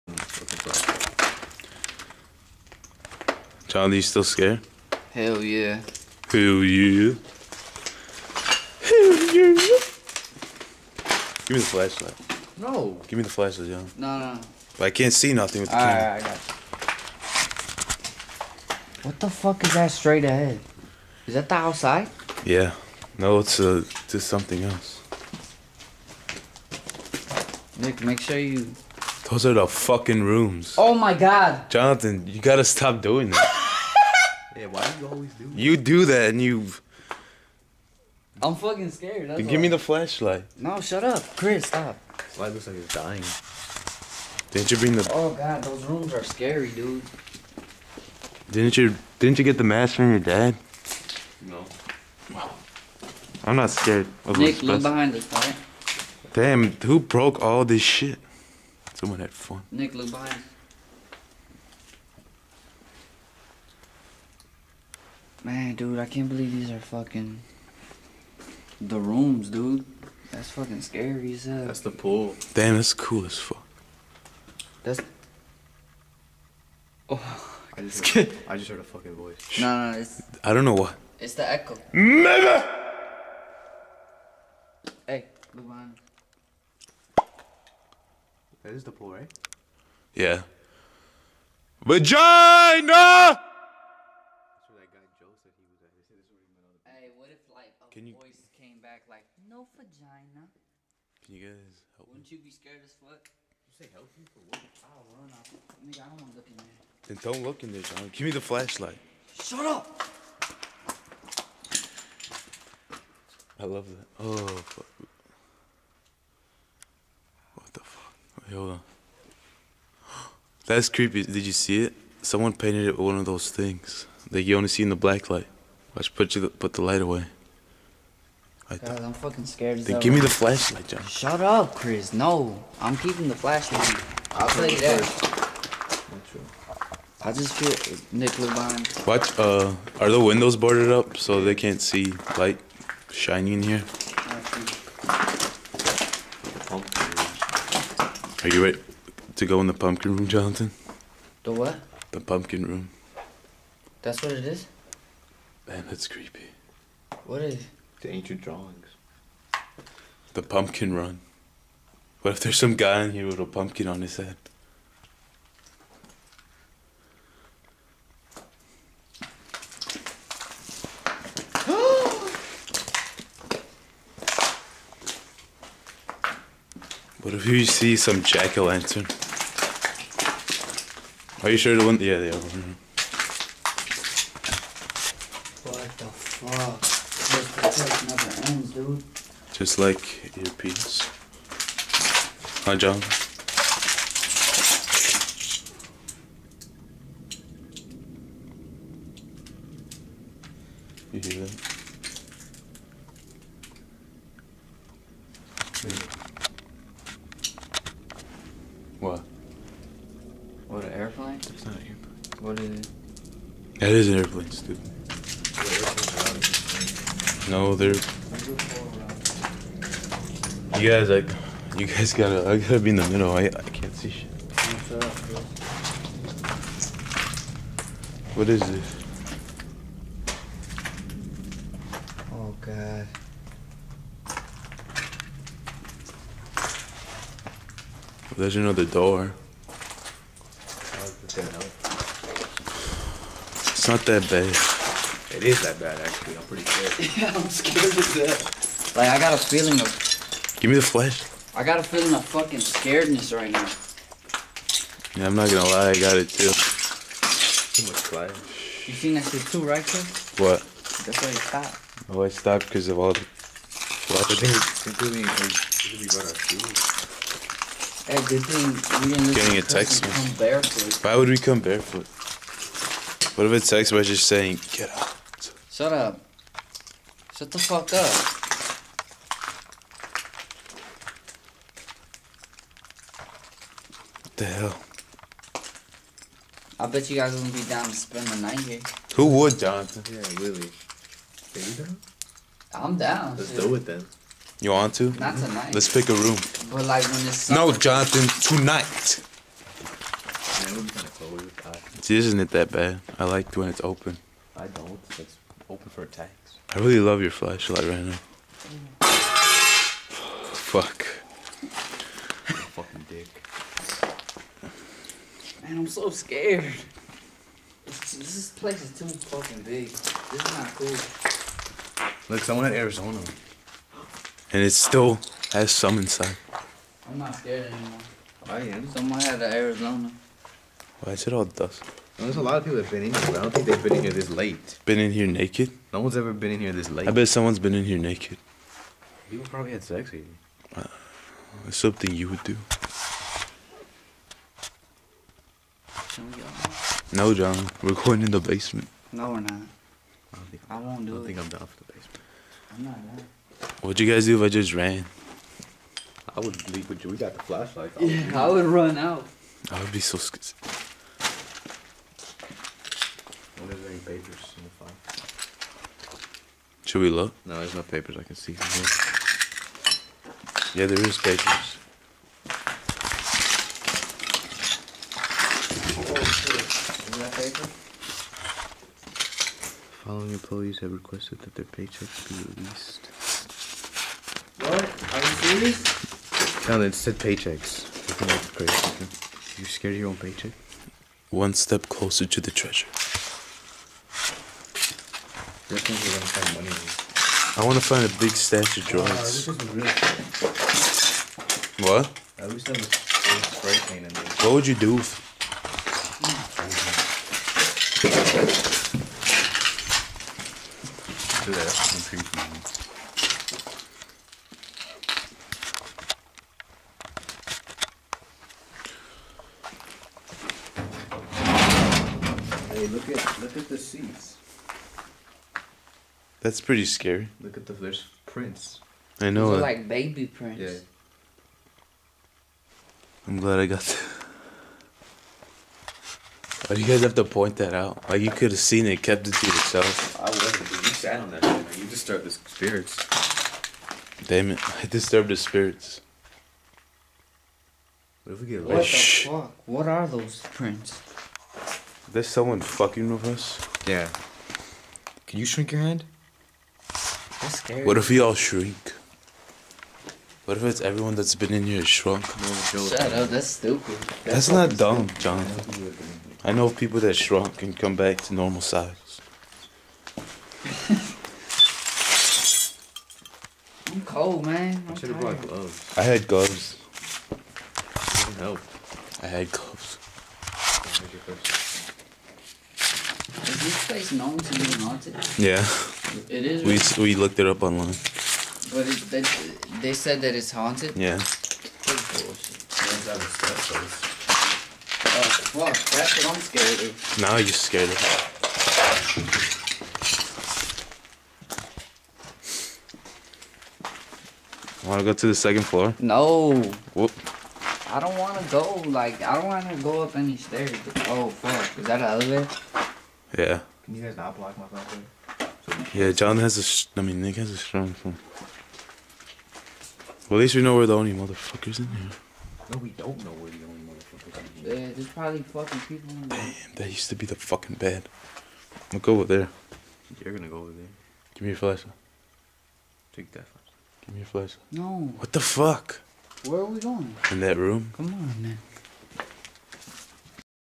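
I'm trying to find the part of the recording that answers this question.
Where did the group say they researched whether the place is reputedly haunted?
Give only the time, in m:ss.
8:07.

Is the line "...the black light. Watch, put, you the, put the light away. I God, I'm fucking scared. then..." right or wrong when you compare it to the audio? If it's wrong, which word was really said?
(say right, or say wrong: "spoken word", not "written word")
right.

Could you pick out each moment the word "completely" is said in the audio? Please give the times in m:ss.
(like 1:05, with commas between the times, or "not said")
4:24.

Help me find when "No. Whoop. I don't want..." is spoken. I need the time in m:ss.
8:25.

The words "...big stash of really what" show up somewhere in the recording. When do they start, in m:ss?
6:38.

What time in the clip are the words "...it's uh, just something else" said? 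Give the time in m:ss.
0:23.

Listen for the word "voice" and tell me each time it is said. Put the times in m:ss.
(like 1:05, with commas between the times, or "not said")
1:19, 1:38.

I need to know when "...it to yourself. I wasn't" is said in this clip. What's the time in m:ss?
7:19.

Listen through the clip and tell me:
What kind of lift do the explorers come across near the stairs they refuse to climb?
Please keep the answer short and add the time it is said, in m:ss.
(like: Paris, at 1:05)
An elevator, at 8:32.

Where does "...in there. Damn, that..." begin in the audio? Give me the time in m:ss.
8:46.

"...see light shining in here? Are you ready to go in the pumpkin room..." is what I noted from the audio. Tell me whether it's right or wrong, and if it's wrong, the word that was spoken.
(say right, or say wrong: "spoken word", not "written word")
right.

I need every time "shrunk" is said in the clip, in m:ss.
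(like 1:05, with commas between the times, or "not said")
7:41, 7:47.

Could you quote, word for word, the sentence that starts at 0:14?
But I can't see nothing with the All camera.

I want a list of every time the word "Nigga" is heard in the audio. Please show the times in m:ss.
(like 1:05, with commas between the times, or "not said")
1:45.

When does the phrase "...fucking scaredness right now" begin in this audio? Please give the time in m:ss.
4:12.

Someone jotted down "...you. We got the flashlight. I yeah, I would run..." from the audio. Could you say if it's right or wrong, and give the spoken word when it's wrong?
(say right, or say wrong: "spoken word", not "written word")
right.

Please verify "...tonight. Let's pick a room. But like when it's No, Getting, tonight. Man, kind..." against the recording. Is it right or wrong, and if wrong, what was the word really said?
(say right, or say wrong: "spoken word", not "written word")
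wrong: "Jonathan", not "Getting".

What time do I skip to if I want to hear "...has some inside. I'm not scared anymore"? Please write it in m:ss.
5:25.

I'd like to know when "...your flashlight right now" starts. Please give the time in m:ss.
5:07.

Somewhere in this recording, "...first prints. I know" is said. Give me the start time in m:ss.
7:07.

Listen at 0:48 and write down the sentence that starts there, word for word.
Didn't you Didn't you get the mask from your dad?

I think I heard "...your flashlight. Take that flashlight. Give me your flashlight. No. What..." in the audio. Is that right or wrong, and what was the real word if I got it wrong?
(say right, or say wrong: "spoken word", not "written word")
right.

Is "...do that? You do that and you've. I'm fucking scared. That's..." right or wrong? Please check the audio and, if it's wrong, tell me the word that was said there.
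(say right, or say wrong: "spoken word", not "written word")
right.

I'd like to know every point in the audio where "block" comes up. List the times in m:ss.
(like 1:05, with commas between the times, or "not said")
8:34.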